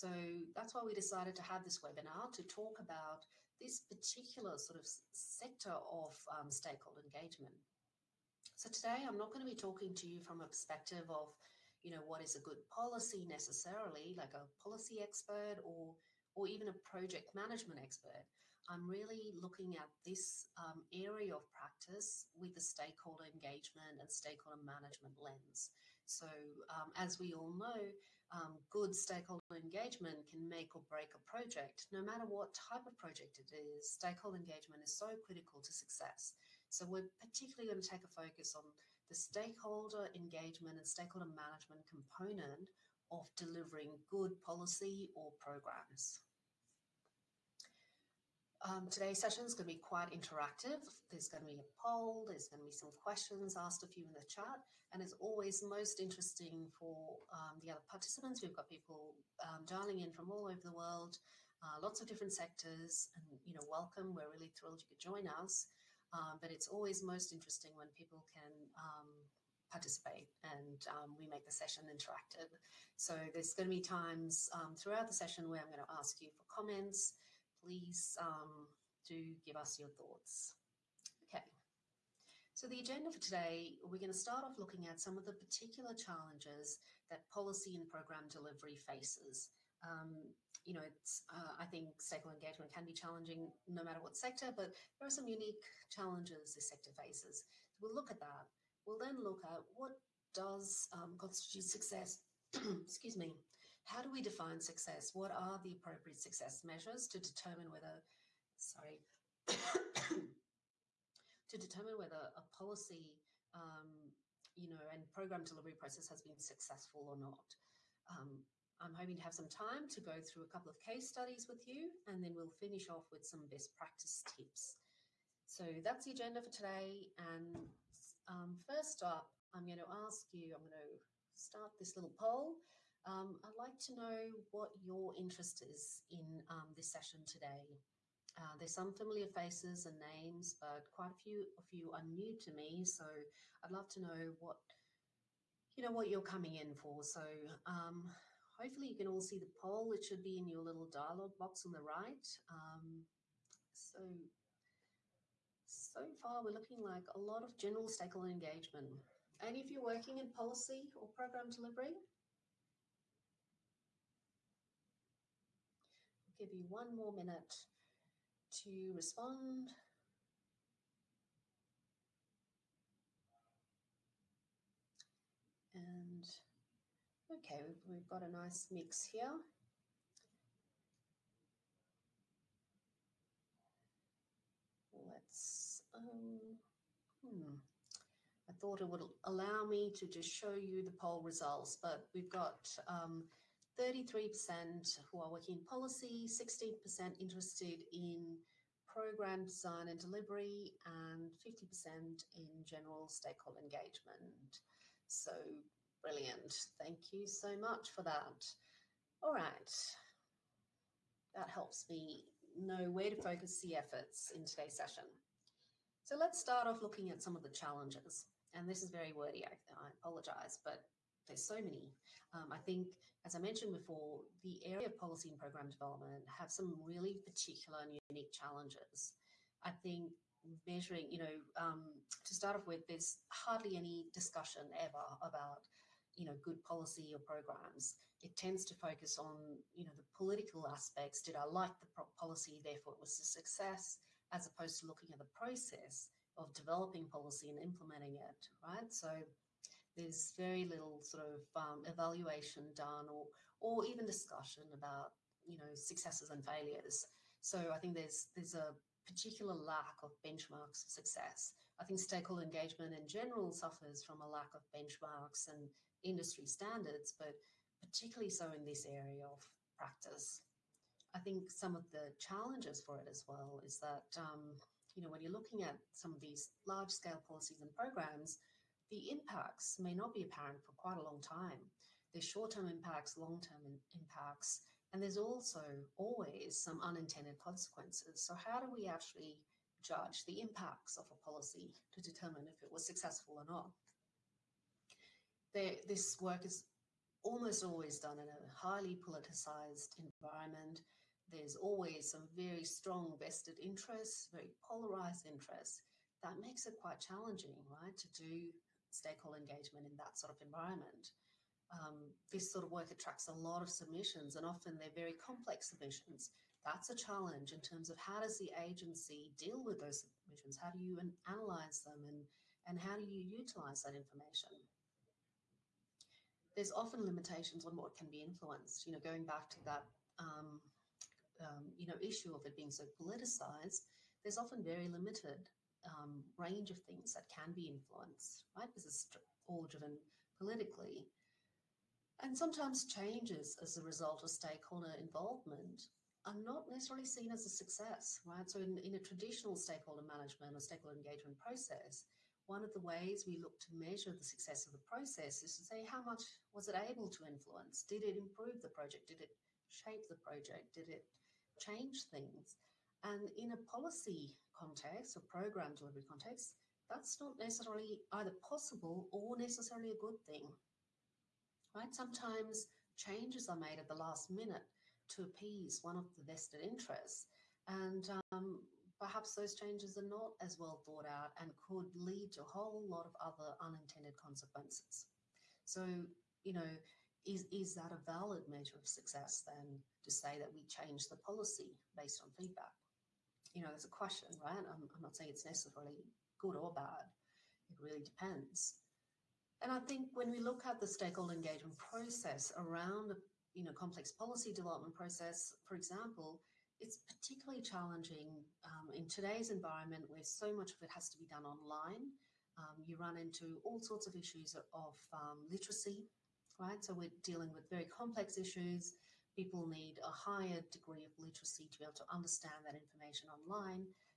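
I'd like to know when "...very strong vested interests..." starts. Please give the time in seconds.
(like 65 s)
302 s.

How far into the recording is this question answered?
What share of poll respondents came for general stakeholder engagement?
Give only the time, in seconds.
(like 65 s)
201 s.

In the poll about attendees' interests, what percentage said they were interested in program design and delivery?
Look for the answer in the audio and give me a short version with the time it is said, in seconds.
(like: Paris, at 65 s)
16%, at 196 s.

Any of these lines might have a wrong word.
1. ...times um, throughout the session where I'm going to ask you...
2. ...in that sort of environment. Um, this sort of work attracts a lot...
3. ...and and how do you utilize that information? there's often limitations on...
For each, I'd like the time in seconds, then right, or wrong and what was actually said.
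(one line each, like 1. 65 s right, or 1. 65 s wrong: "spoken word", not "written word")
1. 73 s right
2. 309 s right
3. 322 s right.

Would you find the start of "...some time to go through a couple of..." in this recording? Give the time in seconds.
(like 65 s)
119 s.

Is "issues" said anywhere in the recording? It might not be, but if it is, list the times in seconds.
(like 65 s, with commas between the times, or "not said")
331 s, 414 s, 418 s.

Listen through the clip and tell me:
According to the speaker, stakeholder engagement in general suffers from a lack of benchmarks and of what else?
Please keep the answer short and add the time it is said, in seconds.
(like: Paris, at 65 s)
industry standards, at 266 s.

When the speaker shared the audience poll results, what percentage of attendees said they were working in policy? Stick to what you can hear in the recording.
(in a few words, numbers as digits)
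33%.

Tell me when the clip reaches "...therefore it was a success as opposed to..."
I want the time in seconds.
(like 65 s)
242 s.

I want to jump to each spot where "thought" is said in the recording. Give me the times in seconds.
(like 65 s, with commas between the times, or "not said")
79 s, 188 s, 380 s.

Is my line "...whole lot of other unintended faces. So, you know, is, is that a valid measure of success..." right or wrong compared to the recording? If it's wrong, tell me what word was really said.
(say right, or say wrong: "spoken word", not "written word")
wrong: "consequences", not "faces".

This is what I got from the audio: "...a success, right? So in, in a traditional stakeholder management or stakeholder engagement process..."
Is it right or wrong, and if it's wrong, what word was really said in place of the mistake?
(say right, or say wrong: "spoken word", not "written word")
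right.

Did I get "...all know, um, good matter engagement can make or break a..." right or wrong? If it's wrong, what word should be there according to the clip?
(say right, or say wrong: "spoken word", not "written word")
wrong: "stakeholder", not "matter".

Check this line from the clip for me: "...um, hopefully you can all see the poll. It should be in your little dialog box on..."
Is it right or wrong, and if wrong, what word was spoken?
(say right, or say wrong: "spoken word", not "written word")
right.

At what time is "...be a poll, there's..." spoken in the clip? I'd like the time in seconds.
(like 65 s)
51 s.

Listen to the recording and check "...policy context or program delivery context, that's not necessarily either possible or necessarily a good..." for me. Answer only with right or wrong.
right.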